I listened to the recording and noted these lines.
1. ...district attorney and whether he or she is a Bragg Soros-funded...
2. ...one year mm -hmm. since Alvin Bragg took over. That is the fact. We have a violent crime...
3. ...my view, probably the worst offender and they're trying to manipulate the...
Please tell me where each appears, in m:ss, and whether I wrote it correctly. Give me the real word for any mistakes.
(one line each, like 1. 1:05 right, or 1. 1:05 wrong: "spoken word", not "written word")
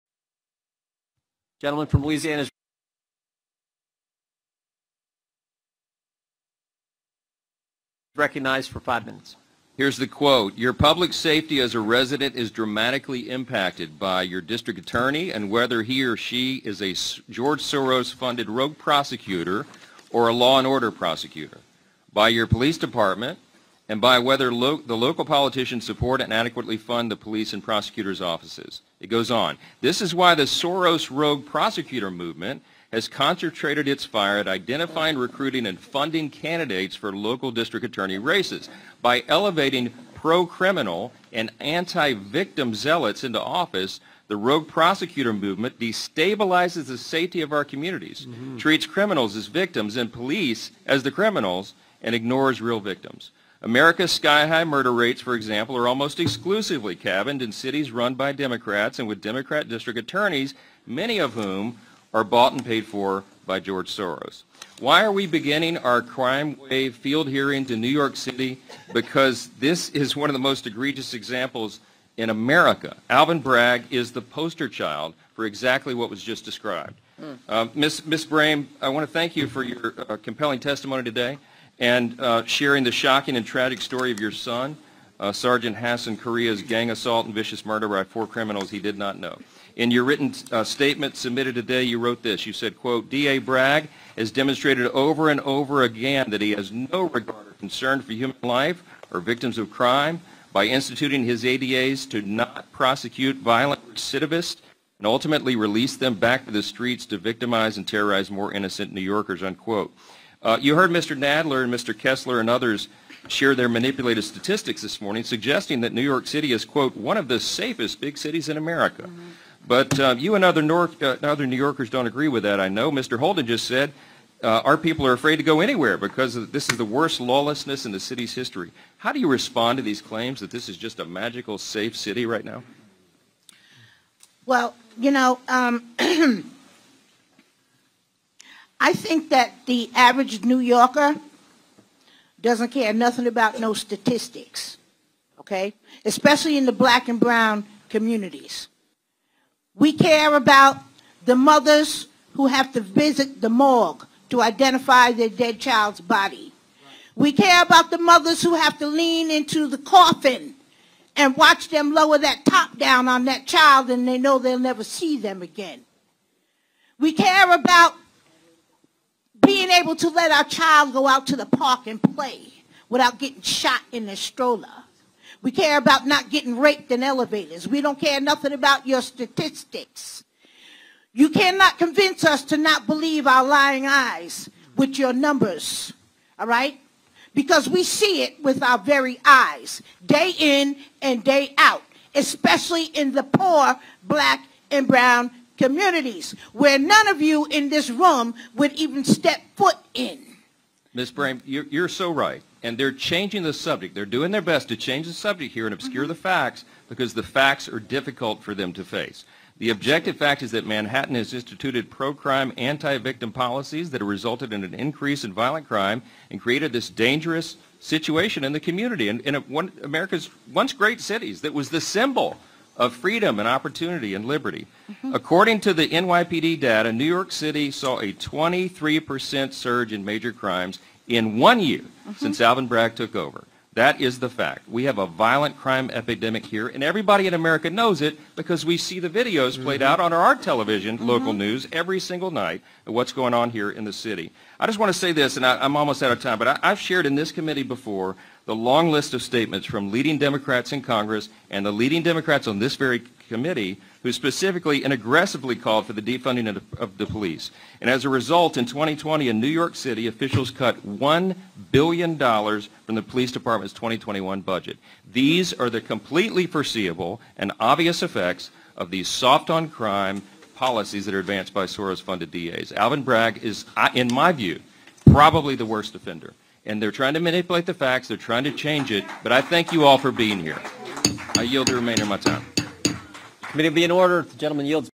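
1. 0:14 wrong: "George", not "Bragg"
2. 3:51 right
3. 4:34 right.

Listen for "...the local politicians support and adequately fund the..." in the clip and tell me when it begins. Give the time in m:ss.
0:24.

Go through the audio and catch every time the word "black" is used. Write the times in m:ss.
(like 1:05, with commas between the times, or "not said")
2:26, 3:14.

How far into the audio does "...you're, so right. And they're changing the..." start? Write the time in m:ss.
3:21.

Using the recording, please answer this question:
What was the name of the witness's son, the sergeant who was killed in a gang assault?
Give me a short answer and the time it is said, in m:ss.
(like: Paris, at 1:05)
Hason Correa, at 1:25.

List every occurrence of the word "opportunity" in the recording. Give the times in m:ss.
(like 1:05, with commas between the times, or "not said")
3:43.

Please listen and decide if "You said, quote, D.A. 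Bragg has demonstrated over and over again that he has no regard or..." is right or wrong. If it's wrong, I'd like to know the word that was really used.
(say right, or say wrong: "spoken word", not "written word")
right.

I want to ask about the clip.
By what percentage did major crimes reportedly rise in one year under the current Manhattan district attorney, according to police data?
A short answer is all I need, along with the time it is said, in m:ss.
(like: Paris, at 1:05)
23%, at 3:48.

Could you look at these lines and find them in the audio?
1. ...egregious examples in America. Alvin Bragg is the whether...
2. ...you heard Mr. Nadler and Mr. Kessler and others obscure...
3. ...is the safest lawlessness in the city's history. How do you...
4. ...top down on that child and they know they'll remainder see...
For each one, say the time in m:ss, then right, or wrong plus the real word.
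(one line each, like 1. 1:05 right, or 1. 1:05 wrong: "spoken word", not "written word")
1. 1:10 wrong: "poster", not "whether"
2. 1:50 wrong: "share", not "obscure"
3. 2:06 wrong: "worst", not "safest"
4. 2:42 wrong: "never", not "remainder".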